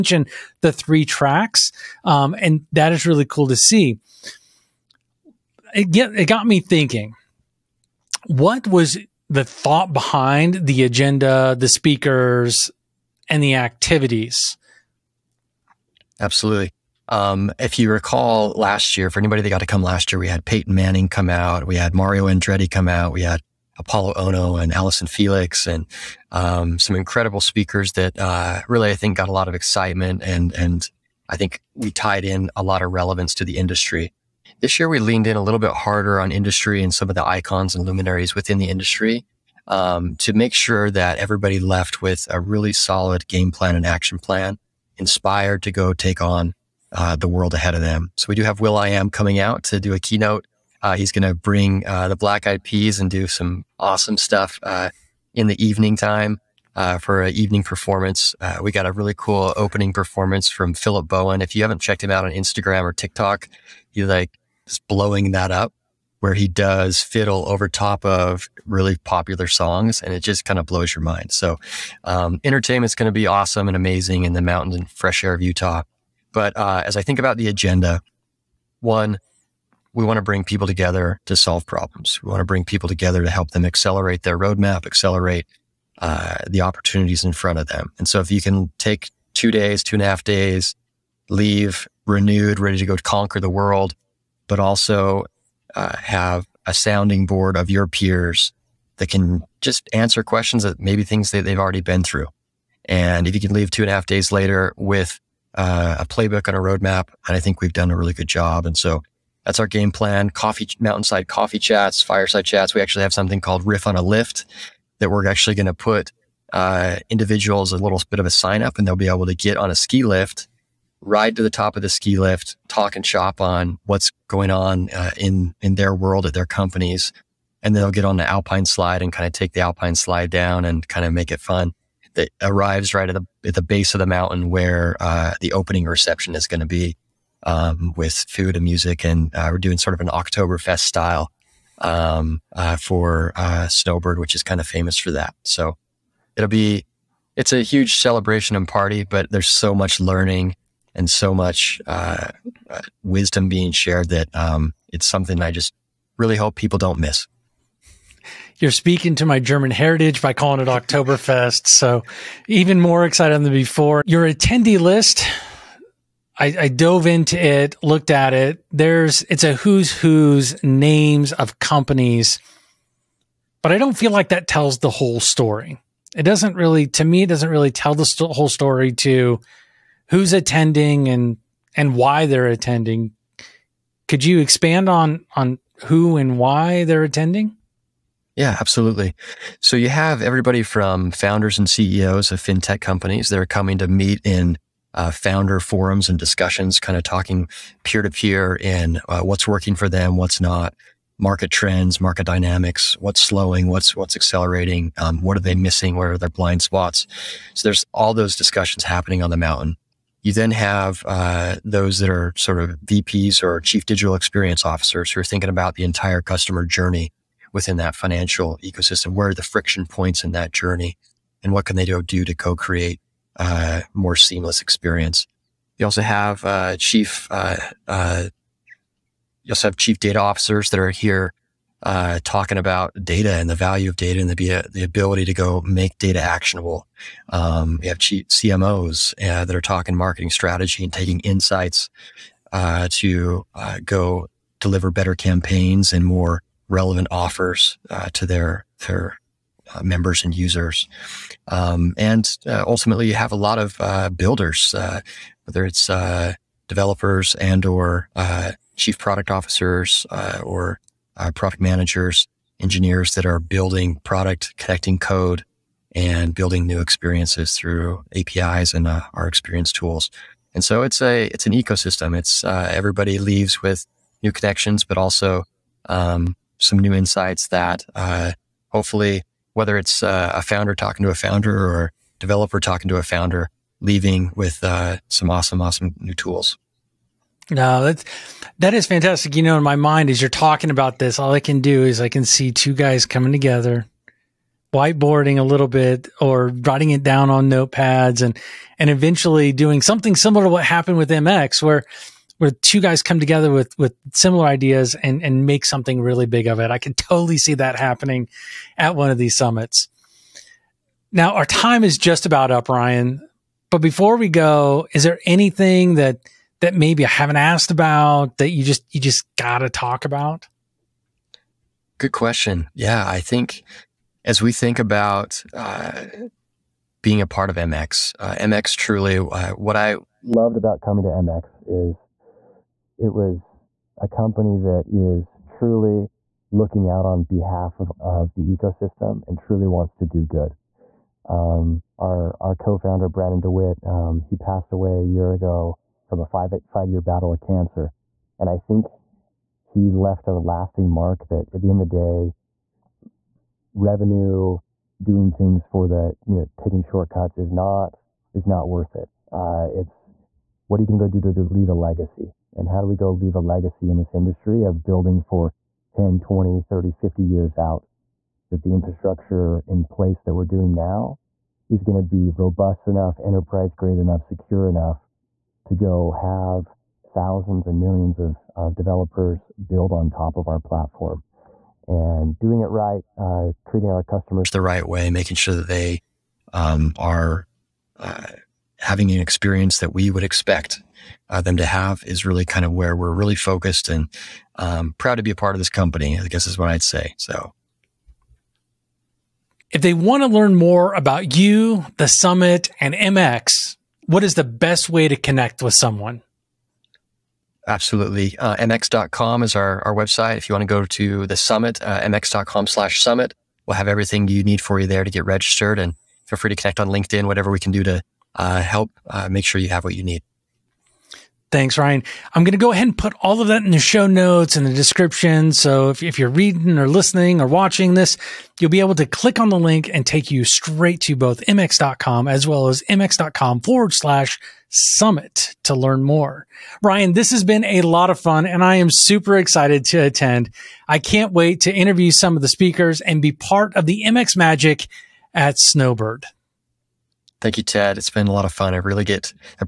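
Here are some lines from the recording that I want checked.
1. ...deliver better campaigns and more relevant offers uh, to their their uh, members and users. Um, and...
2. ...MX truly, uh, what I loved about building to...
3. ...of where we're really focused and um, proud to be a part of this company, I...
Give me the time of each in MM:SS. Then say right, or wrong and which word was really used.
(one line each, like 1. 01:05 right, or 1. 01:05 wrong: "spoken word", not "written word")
1. 04:04 right
2. 05:28 wrong: "coming", not "building"
3. 06:32 right.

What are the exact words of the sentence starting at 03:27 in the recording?
So there's all those discussions happening on the mountain.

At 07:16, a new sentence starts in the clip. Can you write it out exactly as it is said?
Ryan, this has been a lot of fun and I am super excited to attend.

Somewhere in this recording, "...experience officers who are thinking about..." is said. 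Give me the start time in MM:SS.
03:34.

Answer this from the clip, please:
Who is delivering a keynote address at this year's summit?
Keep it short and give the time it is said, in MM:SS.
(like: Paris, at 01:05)
will.i.am, at 00:48.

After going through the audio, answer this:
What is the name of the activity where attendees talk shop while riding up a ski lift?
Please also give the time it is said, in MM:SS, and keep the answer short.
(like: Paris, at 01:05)
Riff on a Lift, at 01:53.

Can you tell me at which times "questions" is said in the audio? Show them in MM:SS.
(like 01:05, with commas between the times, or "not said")
01:40, 05:22.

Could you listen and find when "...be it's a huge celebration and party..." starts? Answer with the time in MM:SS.
02:26.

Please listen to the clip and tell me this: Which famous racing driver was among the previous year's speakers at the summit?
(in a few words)
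Mario Andretti.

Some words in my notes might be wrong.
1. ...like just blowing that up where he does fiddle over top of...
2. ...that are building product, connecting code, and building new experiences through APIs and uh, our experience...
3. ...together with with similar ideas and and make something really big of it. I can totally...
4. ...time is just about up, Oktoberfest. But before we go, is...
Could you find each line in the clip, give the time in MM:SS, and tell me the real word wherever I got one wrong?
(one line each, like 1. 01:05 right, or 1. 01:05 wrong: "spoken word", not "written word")
1. 01:04 right
2. 04:23 right
3. 05:03 right
4. 05:11 wrong: "Ryan", not "Oktoberfest".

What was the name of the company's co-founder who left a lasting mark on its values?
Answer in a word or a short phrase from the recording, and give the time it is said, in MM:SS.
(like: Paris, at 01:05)
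Brandon Dewitt, at 05:43.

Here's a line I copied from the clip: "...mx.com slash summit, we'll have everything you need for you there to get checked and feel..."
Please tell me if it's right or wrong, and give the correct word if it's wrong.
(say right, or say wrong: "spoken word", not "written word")
wrong: "registered", not "checked".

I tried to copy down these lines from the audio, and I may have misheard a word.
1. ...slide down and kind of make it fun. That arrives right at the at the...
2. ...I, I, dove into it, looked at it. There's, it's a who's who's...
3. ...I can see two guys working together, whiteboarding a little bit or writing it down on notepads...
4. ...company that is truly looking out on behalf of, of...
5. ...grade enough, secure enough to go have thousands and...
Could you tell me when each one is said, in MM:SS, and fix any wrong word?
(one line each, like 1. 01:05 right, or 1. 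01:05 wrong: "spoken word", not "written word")
1. 02:09 right
2. 02:46 right
3. 04:51 wrong: "coming", not "working"
4. 05:34 right
5. 06:13 right.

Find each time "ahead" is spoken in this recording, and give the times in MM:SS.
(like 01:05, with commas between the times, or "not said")
00:47, 07:02.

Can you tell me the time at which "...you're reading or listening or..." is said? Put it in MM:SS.
07:06.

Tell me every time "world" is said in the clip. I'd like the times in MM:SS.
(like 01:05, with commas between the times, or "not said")
00:47, 01:33, 02:05.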